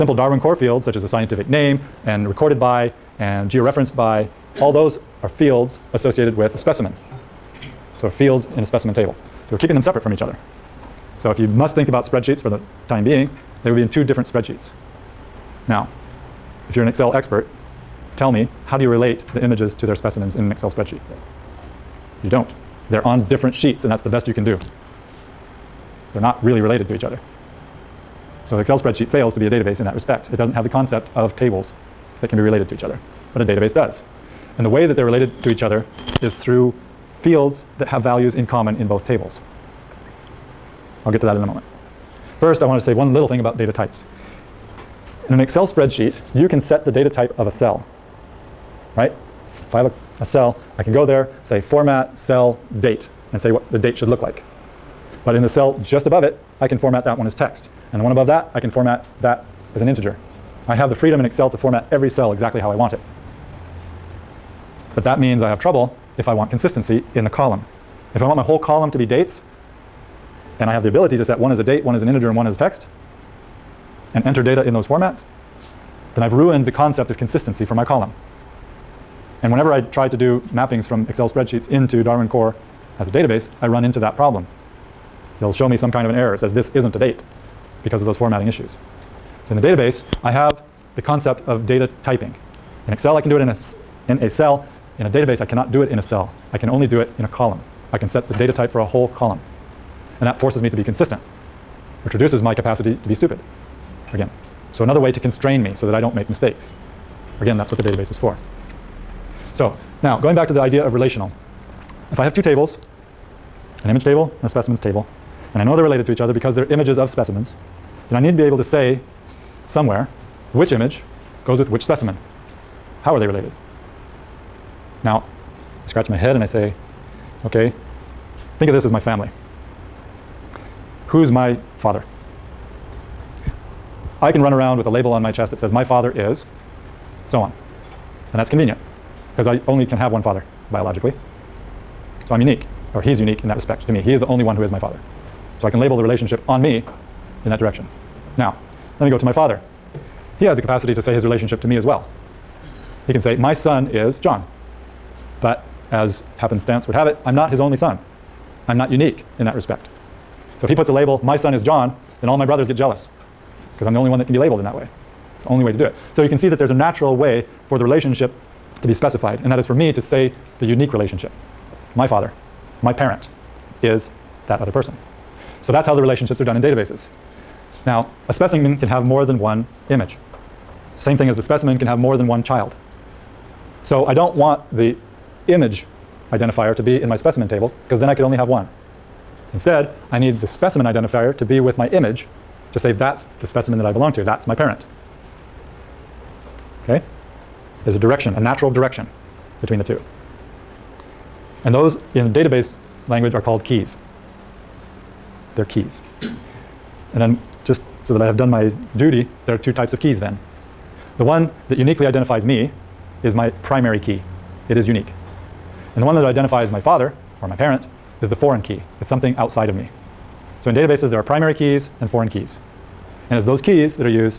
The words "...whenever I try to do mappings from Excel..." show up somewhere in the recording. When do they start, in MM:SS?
01:19.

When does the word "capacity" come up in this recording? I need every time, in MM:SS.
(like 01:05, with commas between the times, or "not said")
01:42, 02:30.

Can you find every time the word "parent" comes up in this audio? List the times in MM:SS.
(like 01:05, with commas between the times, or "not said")
02:52, 03:14, 03:37.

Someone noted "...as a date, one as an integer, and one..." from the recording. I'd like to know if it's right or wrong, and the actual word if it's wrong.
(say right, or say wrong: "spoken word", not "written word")
right.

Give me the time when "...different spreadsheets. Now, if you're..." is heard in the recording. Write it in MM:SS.
00:14.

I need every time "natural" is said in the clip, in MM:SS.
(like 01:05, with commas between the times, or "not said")
02:46, 03:18.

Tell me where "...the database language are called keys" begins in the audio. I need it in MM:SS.
03:22.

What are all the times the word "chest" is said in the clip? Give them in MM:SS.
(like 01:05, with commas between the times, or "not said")
02:15.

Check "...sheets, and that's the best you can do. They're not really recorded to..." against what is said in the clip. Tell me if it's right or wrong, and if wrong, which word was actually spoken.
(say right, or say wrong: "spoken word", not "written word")
wrong: "related", not "recorded".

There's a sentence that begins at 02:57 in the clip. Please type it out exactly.
Now, a specimen can have more than one image.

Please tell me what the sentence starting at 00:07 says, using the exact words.
So fields in a specimen table.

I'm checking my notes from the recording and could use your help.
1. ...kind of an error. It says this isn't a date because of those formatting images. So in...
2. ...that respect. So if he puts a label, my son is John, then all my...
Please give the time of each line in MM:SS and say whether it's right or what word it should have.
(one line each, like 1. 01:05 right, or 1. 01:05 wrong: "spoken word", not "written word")
1. 01:25 wrong: "issues", not "images"
2. 02:39 right.